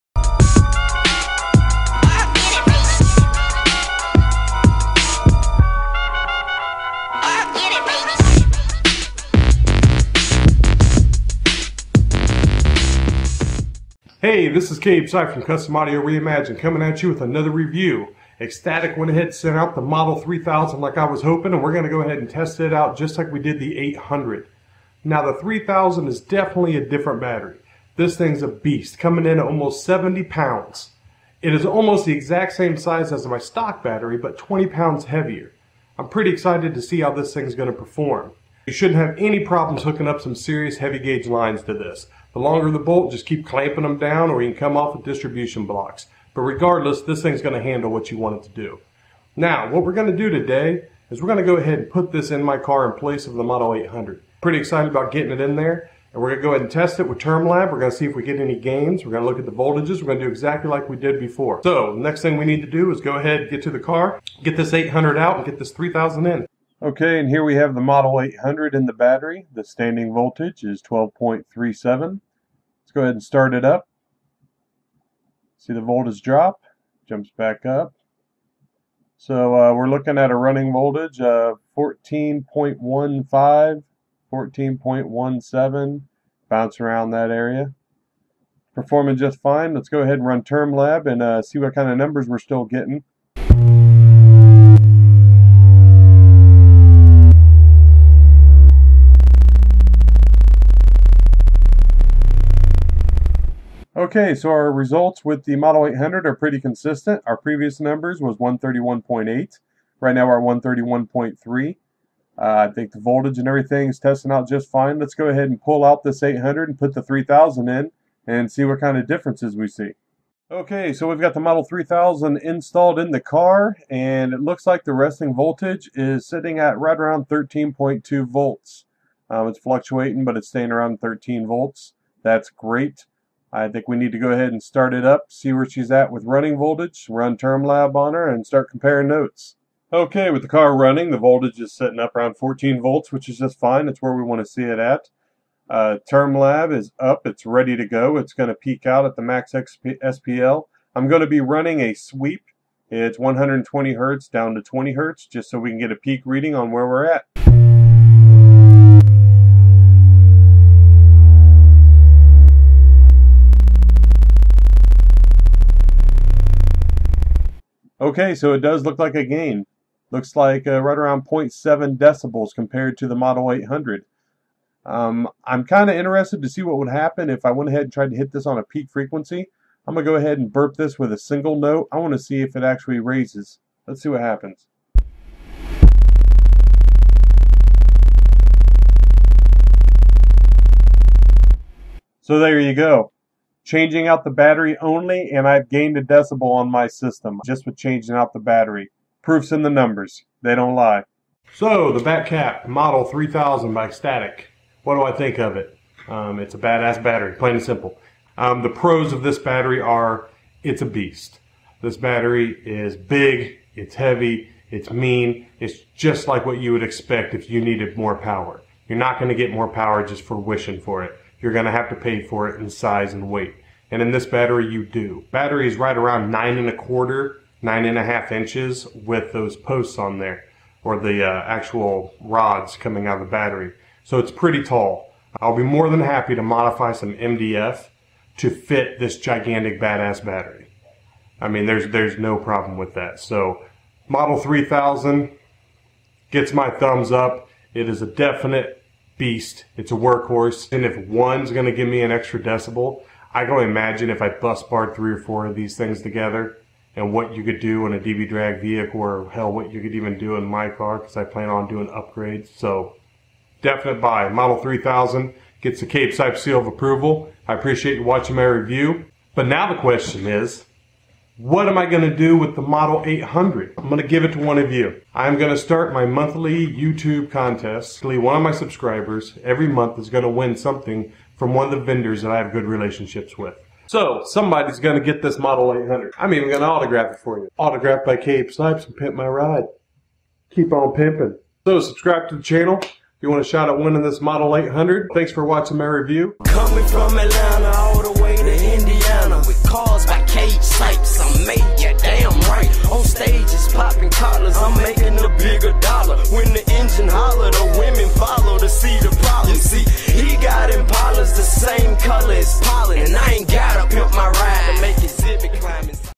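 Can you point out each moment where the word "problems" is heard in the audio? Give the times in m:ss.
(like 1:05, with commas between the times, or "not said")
0:39, 4:02.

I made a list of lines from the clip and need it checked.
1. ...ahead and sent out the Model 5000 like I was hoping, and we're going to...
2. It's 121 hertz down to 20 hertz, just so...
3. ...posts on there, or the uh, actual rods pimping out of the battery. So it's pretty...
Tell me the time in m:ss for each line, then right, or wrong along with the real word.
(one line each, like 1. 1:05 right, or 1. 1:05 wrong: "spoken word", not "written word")
1. 0:19 wrong: "3000", not "5000"
2. 2:32 wrong: "120", not "121"
3. 3:49 wrong: "coming", not "pimping".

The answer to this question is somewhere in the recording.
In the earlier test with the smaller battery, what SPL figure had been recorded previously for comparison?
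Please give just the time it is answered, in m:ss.
1:48.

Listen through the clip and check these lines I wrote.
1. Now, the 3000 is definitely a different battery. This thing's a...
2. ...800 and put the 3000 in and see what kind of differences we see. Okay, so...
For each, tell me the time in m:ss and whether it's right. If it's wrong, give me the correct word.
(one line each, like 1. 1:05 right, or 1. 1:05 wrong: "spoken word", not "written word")
1. 0:25 right
2. 1:56 right.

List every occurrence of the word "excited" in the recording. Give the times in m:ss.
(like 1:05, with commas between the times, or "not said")
0:36, 0:54.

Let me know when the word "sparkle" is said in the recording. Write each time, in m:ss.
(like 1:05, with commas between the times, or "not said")
not said.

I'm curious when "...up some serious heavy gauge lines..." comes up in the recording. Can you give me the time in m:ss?
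0:40.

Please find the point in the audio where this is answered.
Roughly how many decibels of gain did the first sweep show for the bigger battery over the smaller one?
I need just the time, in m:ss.
2:51.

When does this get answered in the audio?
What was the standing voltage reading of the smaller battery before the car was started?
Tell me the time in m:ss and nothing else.
1:10.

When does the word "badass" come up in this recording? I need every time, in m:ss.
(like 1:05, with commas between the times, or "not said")
3:26, 3:59.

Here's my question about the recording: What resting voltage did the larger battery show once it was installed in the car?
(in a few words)
13.2 volts.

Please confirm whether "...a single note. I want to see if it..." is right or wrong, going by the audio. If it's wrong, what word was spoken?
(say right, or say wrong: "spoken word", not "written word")
right.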